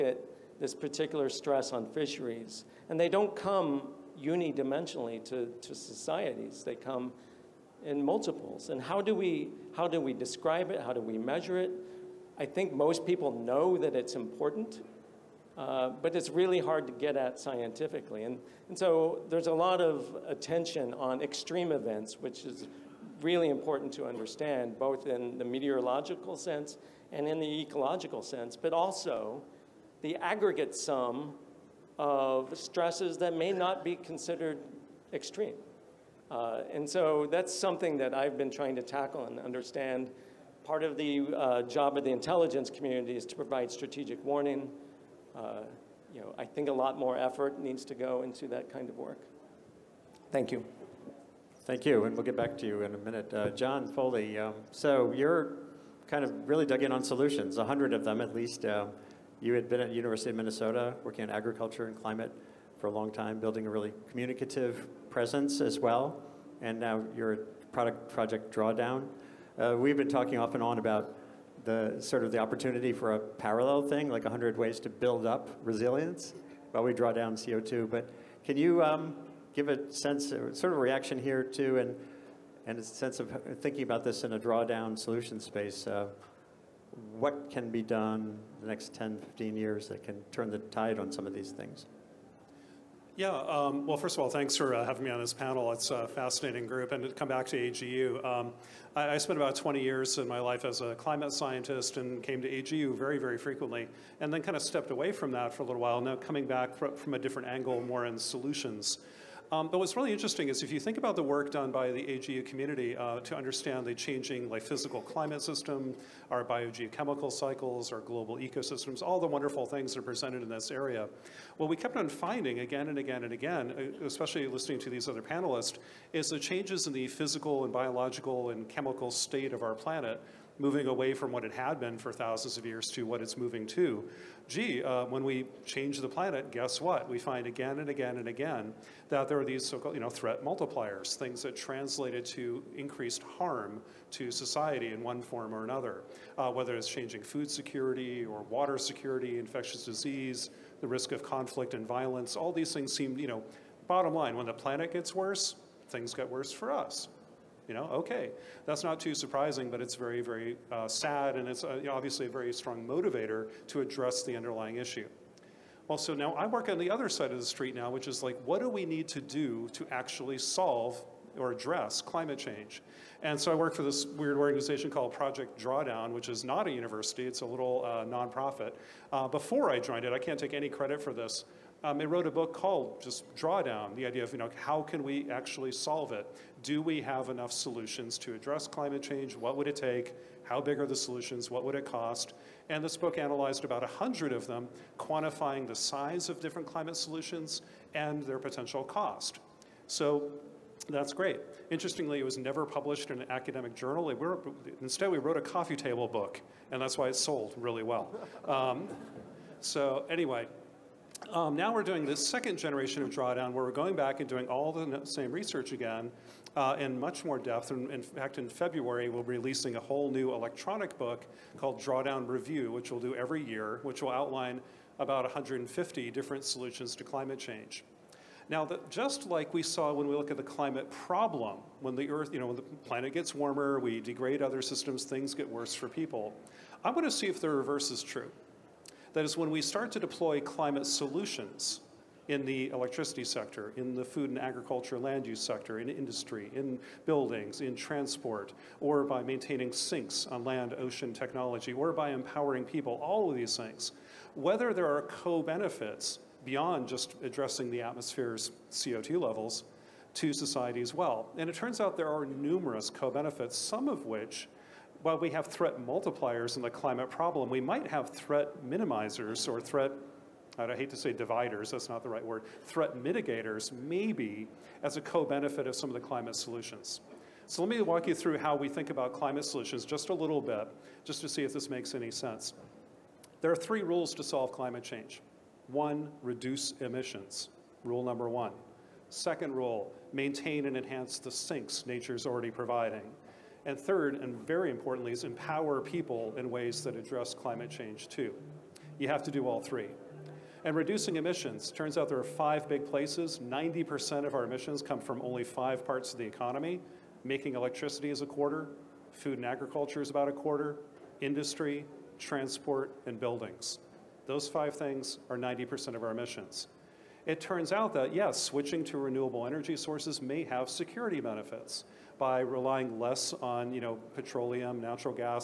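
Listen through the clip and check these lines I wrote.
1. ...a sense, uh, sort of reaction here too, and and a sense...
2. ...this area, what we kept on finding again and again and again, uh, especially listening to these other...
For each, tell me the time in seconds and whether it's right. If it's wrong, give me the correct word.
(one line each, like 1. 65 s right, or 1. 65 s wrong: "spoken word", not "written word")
1. 79 s right
2. 120 s right.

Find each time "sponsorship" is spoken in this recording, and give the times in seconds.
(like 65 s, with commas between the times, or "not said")
not said.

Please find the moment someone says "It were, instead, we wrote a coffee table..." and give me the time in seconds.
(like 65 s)
204 s.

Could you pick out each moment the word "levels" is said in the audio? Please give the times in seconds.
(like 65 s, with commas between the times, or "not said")
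259 s.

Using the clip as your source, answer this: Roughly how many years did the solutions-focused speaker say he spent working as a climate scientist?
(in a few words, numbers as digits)
20.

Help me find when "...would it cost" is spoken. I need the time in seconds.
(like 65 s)
191 s.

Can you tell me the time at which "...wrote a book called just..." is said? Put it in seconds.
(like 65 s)
182 s.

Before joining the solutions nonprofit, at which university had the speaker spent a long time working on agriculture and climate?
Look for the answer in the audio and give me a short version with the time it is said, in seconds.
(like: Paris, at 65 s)
University of Minnesota, at 59 s.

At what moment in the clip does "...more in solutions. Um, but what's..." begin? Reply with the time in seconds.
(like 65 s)
107 s.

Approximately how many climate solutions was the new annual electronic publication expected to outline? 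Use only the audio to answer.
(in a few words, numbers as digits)
150.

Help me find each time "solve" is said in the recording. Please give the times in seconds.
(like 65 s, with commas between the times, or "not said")
170 s, 185 s, 284 s.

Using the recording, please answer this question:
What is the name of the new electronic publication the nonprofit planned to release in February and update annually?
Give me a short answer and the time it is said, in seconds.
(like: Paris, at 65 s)
Drawdown Review, at 221 s.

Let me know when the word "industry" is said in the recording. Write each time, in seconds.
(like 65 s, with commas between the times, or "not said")
245 s, 311 s.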